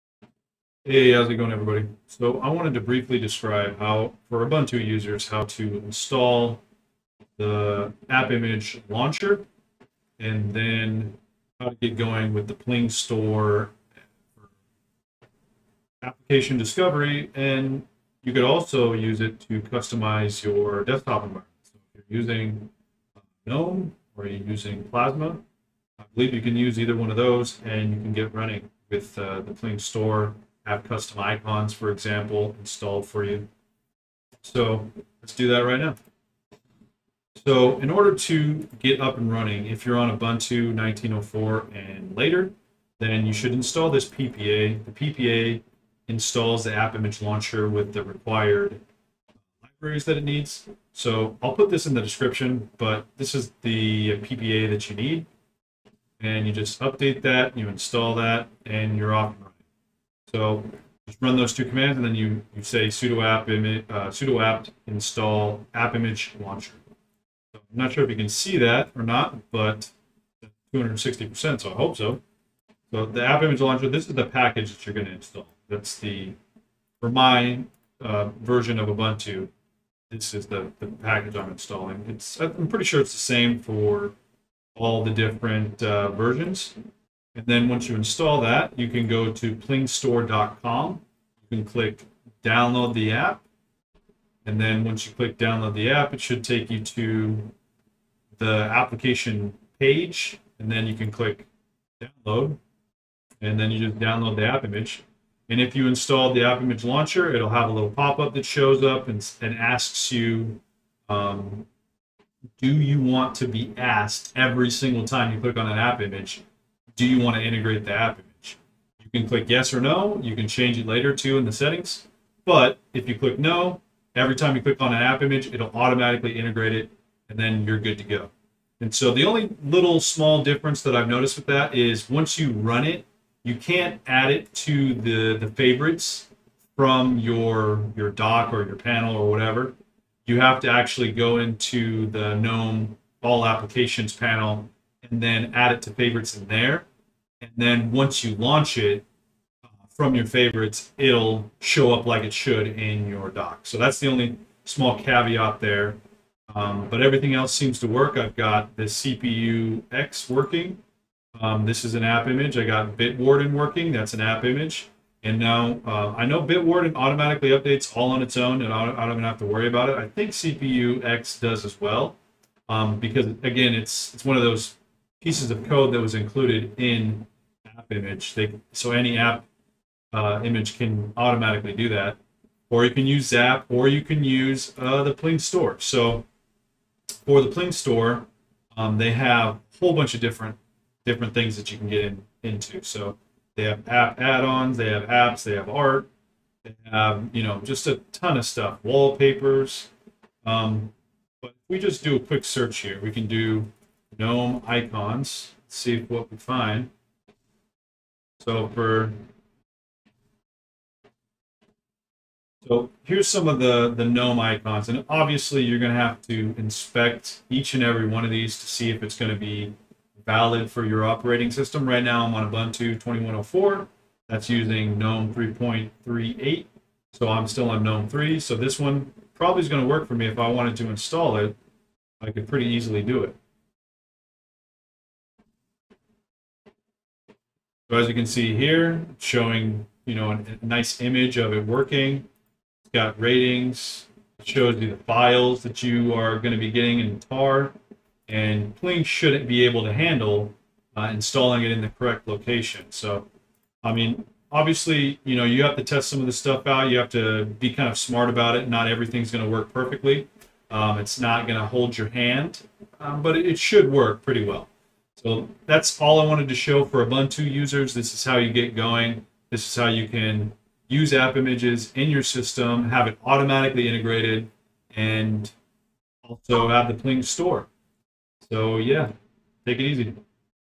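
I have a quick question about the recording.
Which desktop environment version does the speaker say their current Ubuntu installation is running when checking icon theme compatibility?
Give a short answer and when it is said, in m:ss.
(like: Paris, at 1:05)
GNOME 3.38, at 3:44.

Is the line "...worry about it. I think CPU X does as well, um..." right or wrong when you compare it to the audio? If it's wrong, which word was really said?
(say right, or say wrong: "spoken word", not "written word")
right.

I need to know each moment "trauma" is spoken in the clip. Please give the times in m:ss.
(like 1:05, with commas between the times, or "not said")
not said.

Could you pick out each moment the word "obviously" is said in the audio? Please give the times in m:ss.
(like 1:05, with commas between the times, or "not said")
3:35, 4:14.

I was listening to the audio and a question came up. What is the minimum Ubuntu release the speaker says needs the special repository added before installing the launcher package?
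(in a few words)
19.04.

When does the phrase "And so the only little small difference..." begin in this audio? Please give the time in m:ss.
2:08.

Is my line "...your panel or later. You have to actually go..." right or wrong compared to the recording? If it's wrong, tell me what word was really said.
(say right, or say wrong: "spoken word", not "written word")
wrong: "whatever", not "later".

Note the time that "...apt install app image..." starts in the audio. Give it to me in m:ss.
1:04.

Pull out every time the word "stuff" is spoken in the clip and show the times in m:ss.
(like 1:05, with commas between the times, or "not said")
3:18, 4:16.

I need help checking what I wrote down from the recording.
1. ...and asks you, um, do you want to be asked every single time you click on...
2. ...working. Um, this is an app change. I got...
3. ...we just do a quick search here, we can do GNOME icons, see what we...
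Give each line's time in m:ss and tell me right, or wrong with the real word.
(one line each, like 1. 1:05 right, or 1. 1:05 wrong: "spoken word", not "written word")
1. 1:49 right
2. 2:40 wrong: "image", not "change"
3. 3:21 right.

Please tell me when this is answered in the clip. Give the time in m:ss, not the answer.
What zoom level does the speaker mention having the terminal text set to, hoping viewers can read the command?
1:10.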